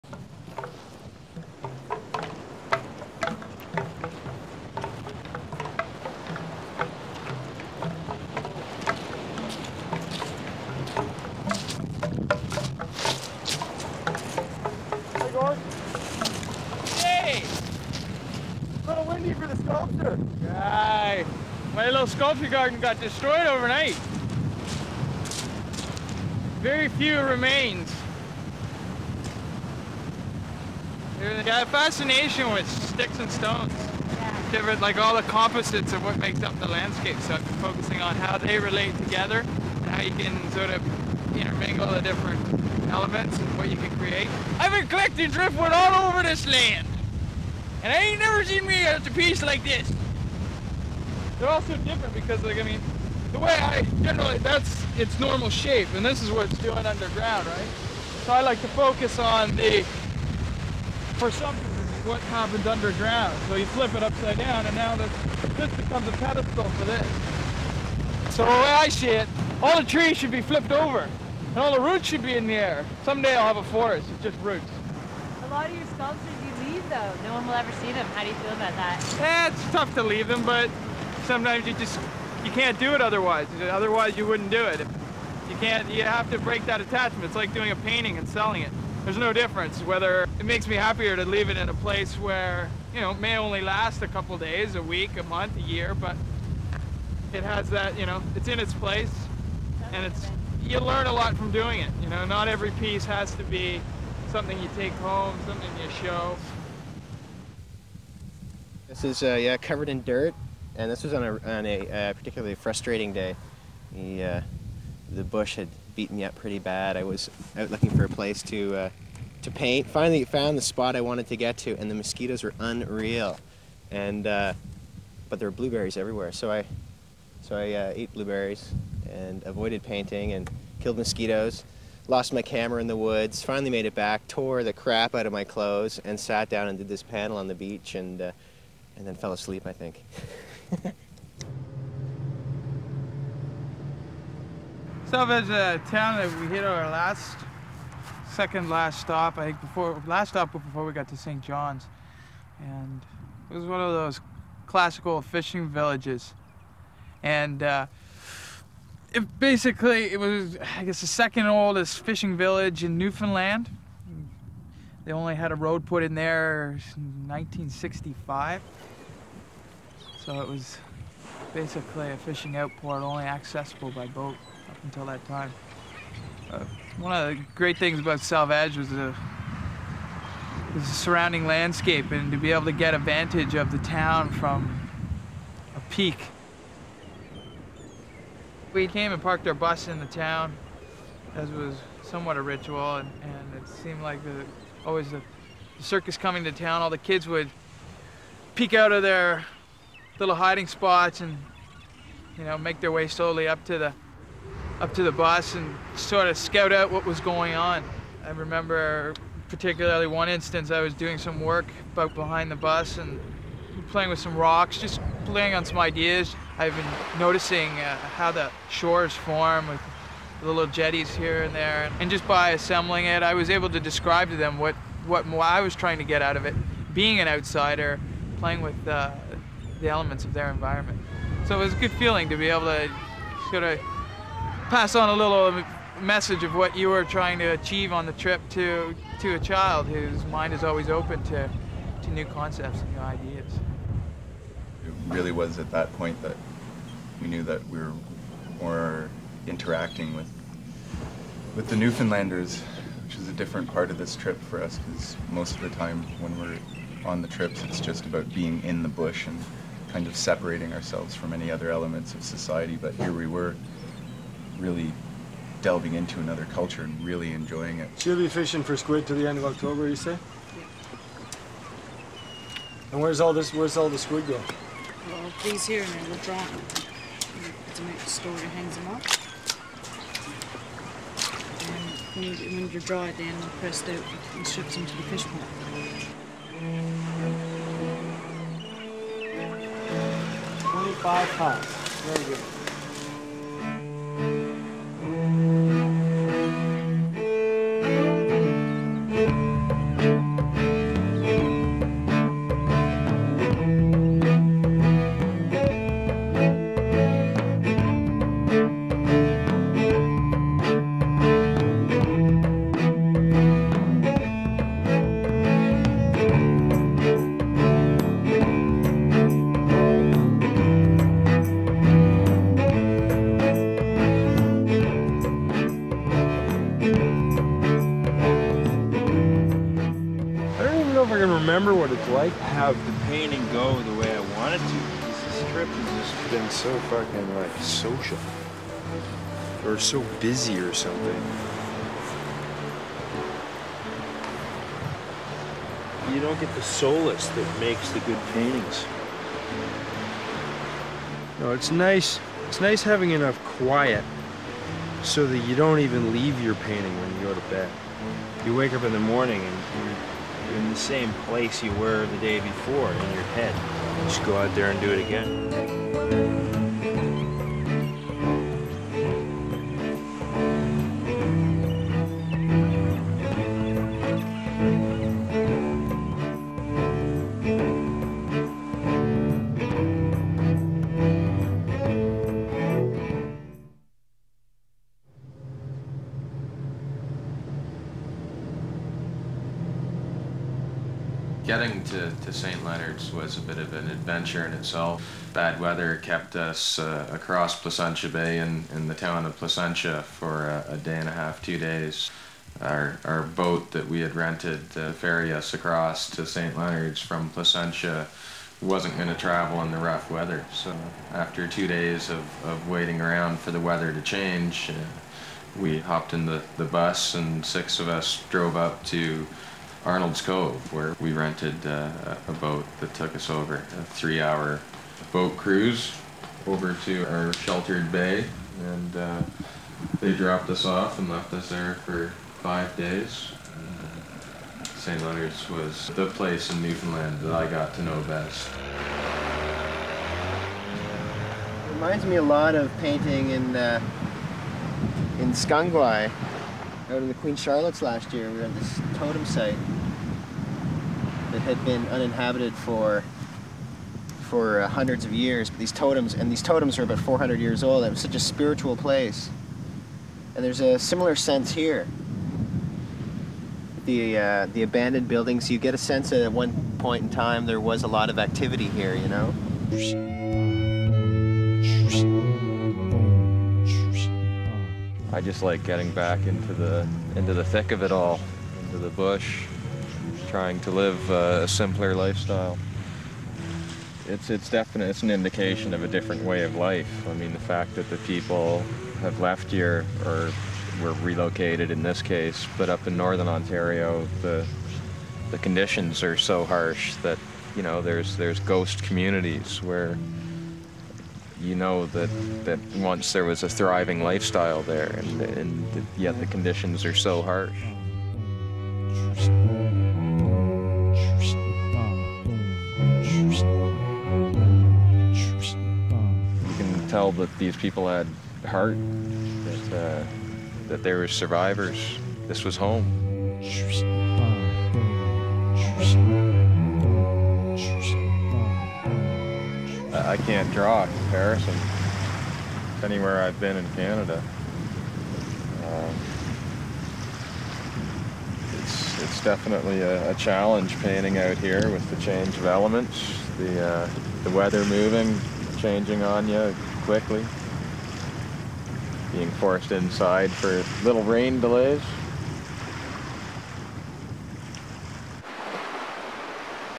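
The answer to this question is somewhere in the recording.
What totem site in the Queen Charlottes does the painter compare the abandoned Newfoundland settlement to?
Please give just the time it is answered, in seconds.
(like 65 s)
445 s.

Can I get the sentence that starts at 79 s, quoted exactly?
Eh, it's tough to leave them, but sometimes you just you can't do it otherwise.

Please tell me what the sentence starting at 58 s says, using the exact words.
So I like to focus on the, for some what happens underground.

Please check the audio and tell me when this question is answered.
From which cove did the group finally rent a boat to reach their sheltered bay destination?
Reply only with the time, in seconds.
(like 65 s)
419 s.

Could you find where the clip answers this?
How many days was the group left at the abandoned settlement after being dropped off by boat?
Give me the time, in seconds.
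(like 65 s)
432 s.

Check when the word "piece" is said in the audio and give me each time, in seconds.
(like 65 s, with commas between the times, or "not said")
49 s, 102 s.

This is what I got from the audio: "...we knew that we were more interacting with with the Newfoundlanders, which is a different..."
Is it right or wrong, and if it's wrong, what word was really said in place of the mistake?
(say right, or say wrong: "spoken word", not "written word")
right.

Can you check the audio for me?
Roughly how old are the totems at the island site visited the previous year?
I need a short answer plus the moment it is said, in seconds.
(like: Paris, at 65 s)
400 years, at 456 s.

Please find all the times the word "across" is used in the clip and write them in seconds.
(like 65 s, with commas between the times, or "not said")
397 s, 405 s.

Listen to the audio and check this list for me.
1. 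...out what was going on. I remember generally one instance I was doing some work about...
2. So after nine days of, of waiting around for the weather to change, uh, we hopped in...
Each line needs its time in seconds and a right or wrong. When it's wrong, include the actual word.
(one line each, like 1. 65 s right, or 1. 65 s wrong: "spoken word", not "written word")
1. 206 s wrong: "particularly", not "generally"
2. 410 s wrong: "two", not "nine".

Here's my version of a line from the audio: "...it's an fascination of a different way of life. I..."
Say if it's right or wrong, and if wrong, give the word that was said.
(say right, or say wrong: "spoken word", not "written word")
wrong: "indication", not "fascination".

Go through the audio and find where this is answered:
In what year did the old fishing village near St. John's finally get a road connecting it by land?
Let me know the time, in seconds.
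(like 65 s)
167 s.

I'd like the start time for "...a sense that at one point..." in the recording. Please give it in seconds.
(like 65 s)
465 s.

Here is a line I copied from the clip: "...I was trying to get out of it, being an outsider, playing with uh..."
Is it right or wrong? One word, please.
right.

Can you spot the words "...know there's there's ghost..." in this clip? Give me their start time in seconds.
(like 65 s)
497 s.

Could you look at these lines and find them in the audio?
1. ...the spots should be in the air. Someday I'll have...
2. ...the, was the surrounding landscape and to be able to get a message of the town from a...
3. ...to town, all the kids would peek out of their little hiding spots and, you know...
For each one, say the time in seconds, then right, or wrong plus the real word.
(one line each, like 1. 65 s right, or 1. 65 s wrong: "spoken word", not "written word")
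1. 71 s wrong: "roots", not "spots"
2. 178 s wrong: "vantage", not "message"
3. 196 s right.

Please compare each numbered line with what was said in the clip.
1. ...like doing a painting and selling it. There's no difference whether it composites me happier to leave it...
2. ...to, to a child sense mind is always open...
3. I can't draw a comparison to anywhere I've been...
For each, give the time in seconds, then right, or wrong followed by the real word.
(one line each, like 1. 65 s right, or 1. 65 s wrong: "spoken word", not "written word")
1. 87 s wrong: "makes", not "composites"
2. 238 s wrong: "whose", not "sense"
3. 530 s right.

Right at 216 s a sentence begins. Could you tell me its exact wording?
I've been noticing uh, how the shores form with the little jetties here and there.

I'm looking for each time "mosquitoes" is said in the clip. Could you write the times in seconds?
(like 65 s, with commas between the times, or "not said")
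121 s, 130 s.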